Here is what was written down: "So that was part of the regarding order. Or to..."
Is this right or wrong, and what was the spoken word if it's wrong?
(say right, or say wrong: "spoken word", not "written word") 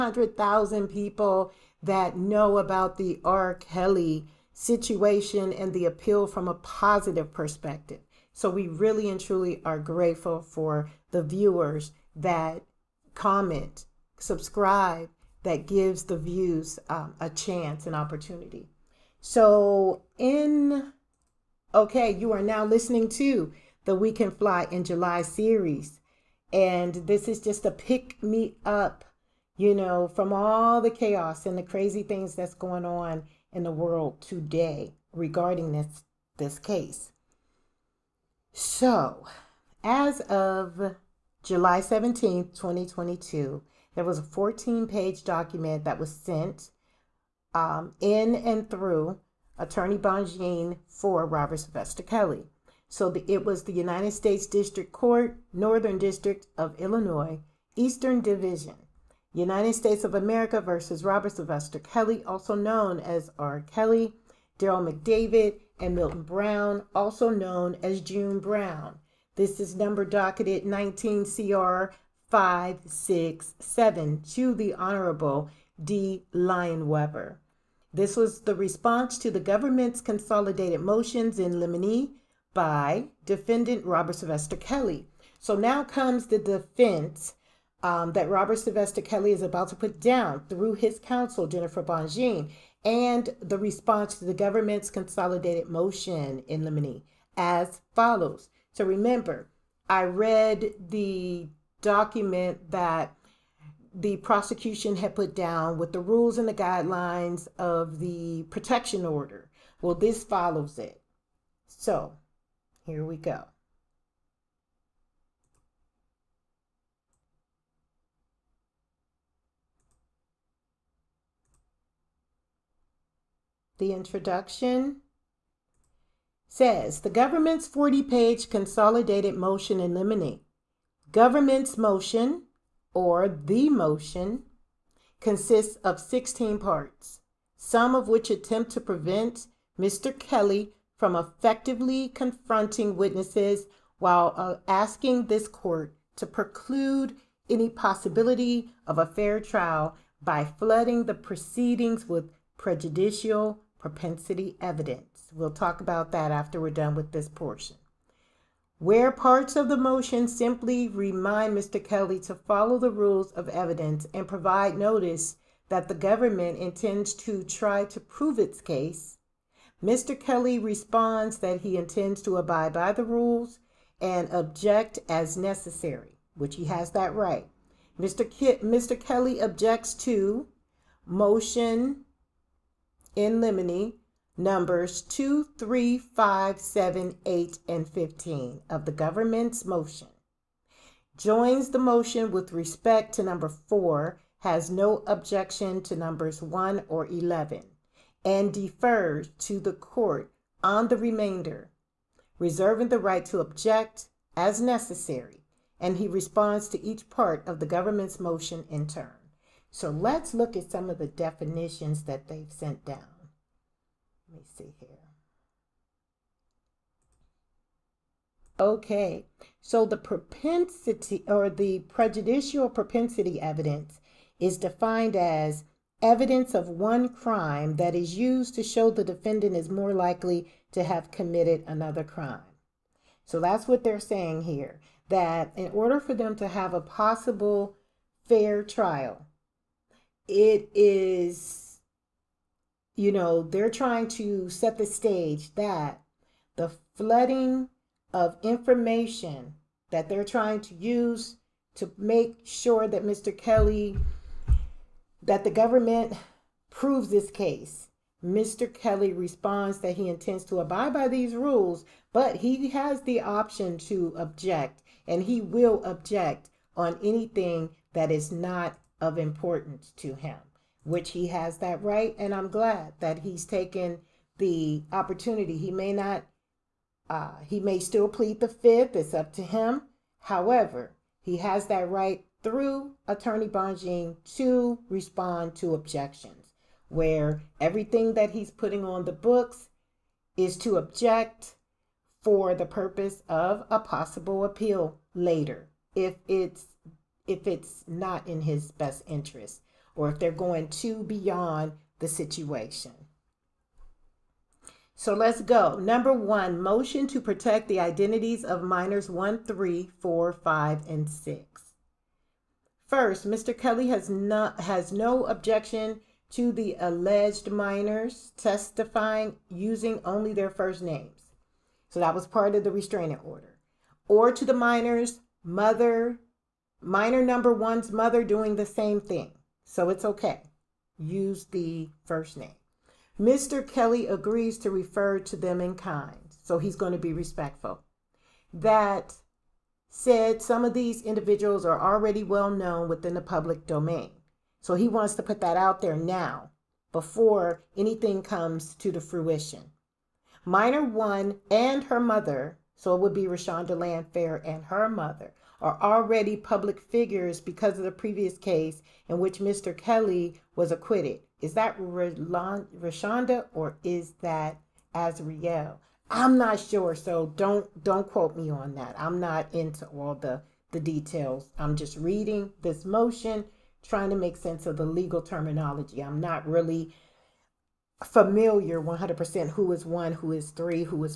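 wrong: "restraining", not "regarding".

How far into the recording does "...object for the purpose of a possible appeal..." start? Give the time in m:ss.
4:50.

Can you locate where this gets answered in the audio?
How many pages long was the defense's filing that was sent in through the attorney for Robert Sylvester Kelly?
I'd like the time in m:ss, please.
0:44.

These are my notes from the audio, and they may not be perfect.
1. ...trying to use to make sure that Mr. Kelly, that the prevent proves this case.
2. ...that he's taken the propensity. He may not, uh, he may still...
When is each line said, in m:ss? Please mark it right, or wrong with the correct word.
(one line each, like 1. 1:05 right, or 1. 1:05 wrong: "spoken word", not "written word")
1. 4:10 wrong: "government", not "prevent"
2. 4:32 wrong: "opportunity", not "propensity".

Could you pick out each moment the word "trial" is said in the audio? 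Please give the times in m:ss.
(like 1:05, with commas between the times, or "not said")
2:29, 3:58.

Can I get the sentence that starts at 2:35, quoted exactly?
We'll talk about that after we're done with this portion.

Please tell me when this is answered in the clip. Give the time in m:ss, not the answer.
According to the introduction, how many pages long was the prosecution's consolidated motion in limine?
2:07.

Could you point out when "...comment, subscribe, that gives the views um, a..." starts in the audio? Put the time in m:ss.
0:13.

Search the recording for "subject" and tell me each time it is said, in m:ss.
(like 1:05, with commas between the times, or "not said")
not said.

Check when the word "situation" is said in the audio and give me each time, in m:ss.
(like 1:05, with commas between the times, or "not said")
0:04, 5:02.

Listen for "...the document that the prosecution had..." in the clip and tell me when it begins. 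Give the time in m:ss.
1:40.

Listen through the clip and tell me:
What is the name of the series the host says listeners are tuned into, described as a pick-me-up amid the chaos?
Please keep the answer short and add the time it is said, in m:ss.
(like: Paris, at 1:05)
We Can Fly in July, at 0:23.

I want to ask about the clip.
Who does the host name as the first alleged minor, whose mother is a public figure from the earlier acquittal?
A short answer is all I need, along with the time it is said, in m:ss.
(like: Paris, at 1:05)
Rashonda Landfair, at 5:53.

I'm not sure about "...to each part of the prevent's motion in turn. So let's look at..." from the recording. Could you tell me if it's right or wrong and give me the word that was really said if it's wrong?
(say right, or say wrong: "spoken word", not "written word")
wrong: "government", not "prevent".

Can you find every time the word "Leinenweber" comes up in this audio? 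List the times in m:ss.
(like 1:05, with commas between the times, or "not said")
1:16.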